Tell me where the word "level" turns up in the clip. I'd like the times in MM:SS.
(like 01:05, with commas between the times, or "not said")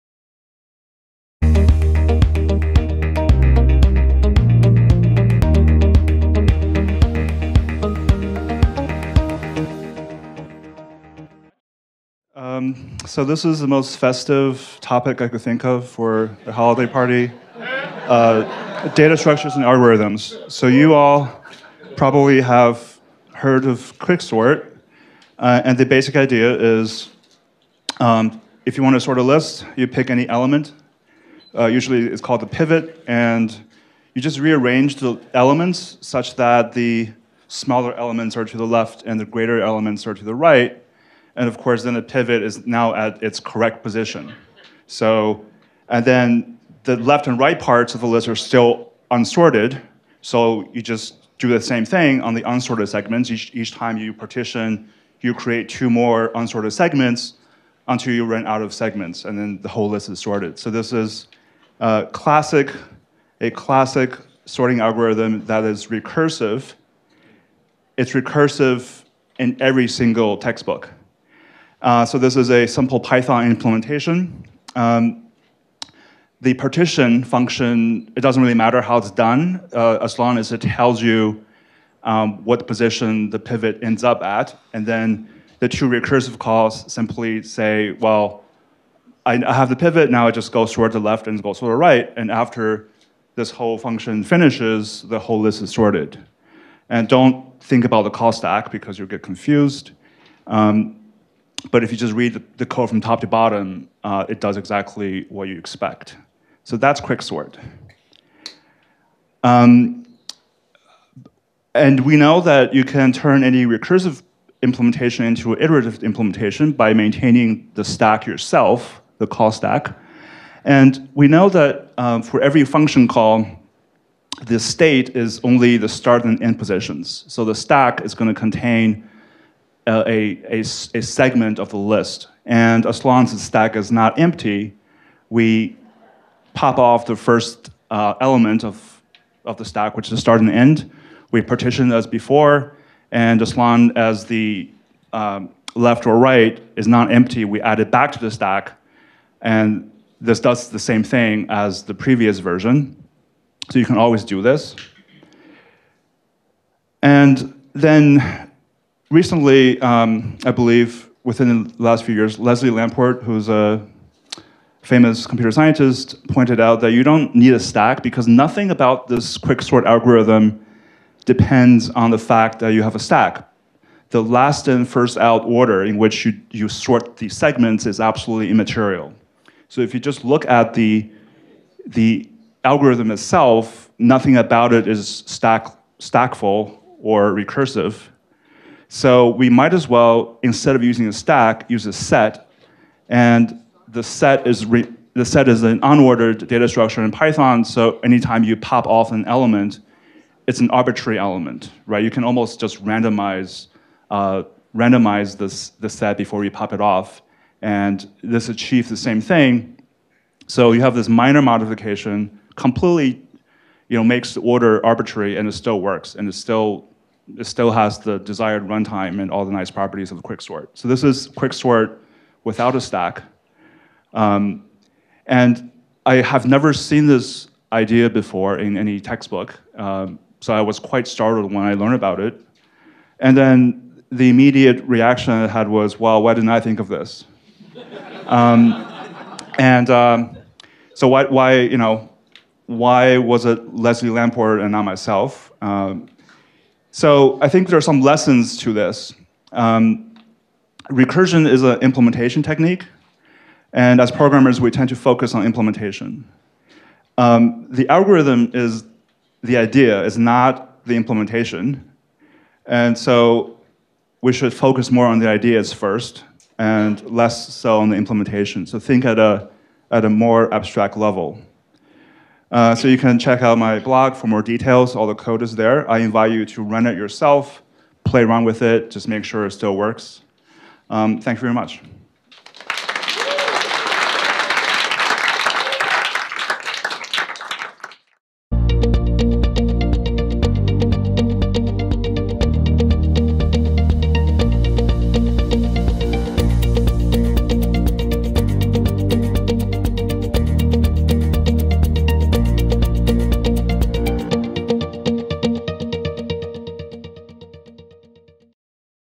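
04:30.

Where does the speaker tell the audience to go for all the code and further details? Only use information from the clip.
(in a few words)
my blog.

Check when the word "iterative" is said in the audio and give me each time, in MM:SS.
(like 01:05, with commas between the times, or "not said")
01:55.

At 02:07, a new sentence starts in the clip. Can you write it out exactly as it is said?
So the stack is going to contain a, a, a, segment of the list.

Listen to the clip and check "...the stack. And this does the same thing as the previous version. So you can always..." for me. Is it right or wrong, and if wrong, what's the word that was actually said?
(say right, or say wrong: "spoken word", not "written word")
right.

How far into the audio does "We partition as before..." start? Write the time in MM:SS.
02:21.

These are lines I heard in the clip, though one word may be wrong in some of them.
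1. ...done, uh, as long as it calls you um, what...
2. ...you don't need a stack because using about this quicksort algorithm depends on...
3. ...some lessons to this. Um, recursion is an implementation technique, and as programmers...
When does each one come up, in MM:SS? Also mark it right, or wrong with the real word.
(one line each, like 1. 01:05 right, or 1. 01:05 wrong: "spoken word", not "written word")
1. 01:19 wrong: "tells", not "calls"
2. 02:46 wrong: "nothing", not "using"
3. 04:07 right.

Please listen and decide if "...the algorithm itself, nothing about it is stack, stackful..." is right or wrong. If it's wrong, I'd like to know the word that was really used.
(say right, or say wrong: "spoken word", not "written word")
right.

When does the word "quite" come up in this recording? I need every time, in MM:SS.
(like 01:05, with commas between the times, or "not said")
03:50.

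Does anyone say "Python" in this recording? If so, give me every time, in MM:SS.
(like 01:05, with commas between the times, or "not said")
01:12, 03:17.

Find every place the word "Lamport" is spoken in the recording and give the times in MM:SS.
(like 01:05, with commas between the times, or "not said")
02:42, 04:04.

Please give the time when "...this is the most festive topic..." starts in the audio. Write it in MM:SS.
00:13.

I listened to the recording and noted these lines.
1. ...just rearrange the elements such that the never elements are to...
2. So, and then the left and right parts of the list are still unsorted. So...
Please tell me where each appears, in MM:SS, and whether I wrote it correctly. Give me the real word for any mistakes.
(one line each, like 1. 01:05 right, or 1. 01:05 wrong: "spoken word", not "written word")
1. 00:34 wrong: "smaller", not "never"
2. 00:44 right.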